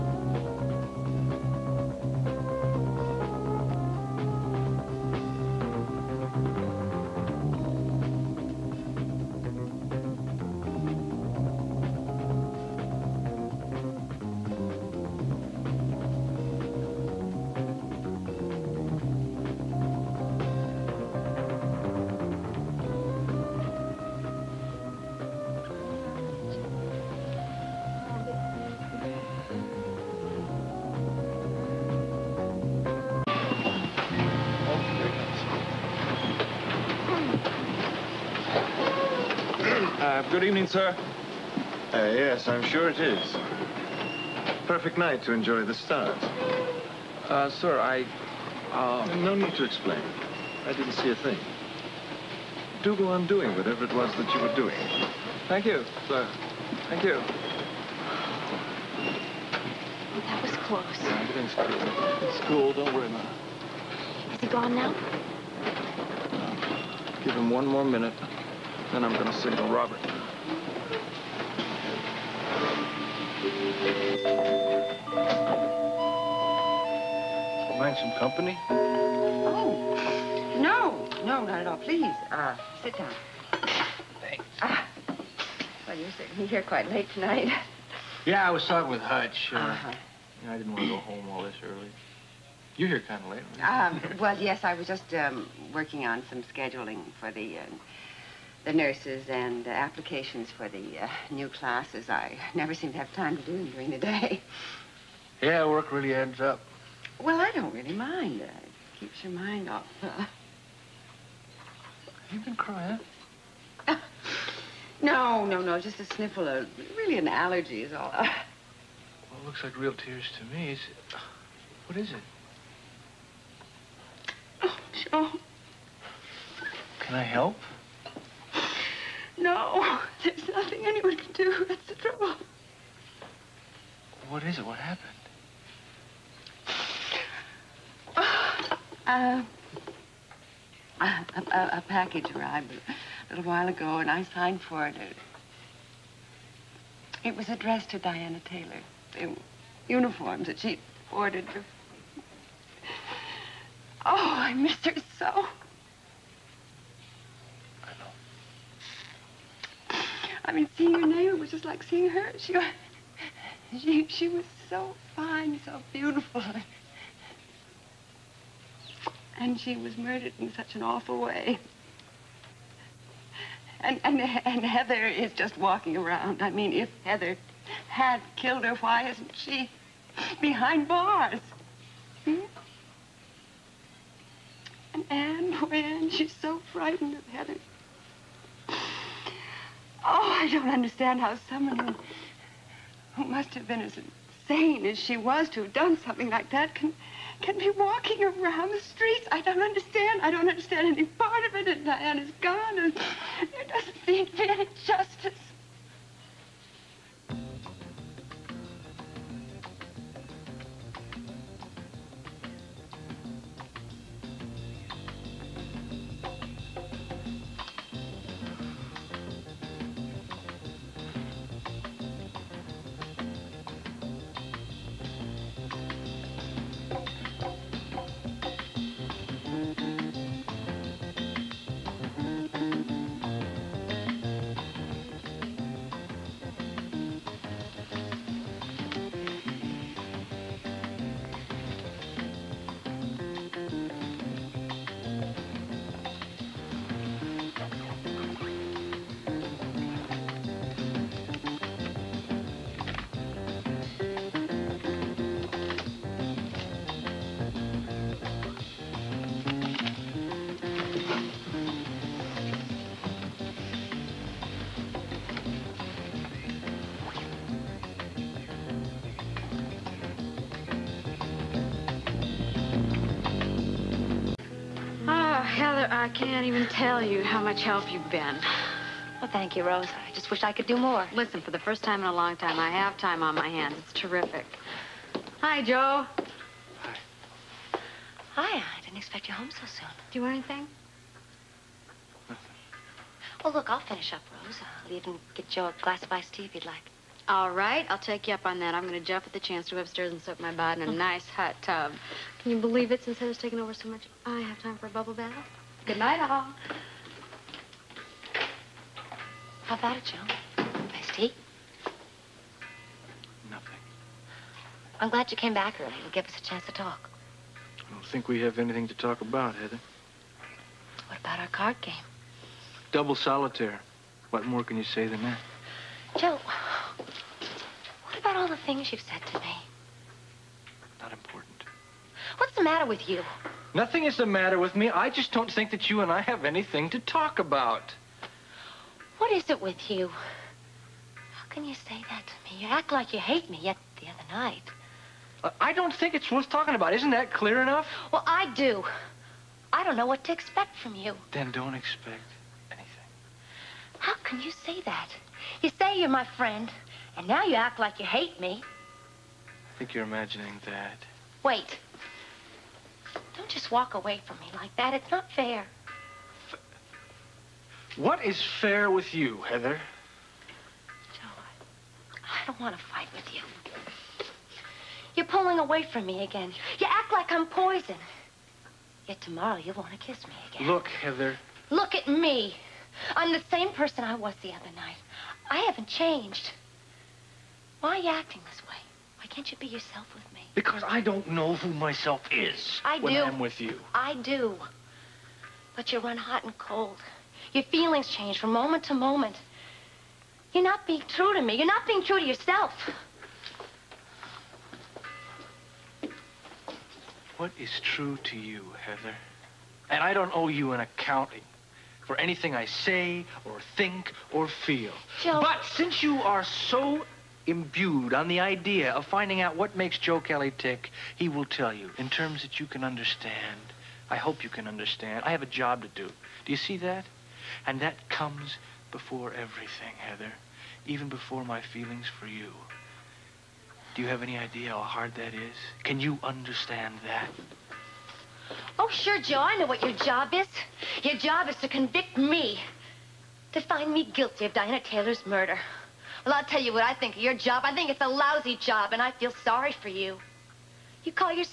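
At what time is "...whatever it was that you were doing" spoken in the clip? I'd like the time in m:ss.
0:53.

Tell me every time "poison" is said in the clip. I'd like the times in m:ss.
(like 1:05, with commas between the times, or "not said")
6:17.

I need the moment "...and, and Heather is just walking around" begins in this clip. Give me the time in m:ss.
2:54.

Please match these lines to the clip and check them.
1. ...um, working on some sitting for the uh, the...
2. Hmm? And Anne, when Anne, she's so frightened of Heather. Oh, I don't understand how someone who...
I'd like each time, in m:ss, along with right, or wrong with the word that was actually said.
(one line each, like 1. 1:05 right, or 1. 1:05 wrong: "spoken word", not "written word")
1. 1:35 wrong: "scheduling", not "sitting"
2. 3:02 right.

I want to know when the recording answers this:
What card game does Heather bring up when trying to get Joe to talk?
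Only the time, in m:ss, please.
5:22.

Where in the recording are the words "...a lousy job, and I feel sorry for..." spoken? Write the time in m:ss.
7:28.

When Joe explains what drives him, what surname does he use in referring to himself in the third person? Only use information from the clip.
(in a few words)
Kelly.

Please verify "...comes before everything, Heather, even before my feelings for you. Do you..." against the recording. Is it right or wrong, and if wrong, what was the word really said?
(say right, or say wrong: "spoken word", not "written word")
right.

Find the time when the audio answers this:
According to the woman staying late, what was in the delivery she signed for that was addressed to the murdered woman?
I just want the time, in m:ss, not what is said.
2:29.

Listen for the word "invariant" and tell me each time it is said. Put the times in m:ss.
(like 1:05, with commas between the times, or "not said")
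not said.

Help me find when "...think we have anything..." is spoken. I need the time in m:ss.
5:18.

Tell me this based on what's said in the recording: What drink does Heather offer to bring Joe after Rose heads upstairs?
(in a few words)
Iced tea.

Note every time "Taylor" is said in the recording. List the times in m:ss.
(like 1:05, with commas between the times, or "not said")
2:28, 7:24.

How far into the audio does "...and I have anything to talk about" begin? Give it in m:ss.
5:36.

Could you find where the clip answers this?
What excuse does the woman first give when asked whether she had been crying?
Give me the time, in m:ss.
1:57.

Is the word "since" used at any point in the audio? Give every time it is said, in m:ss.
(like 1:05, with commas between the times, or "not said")
5:03, 6:55.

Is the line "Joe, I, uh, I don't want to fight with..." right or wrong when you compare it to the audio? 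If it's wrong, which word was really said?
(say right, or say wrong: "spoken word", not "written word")
right.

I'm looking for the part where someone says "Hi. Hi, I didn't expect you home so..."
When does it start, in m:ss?
4:46.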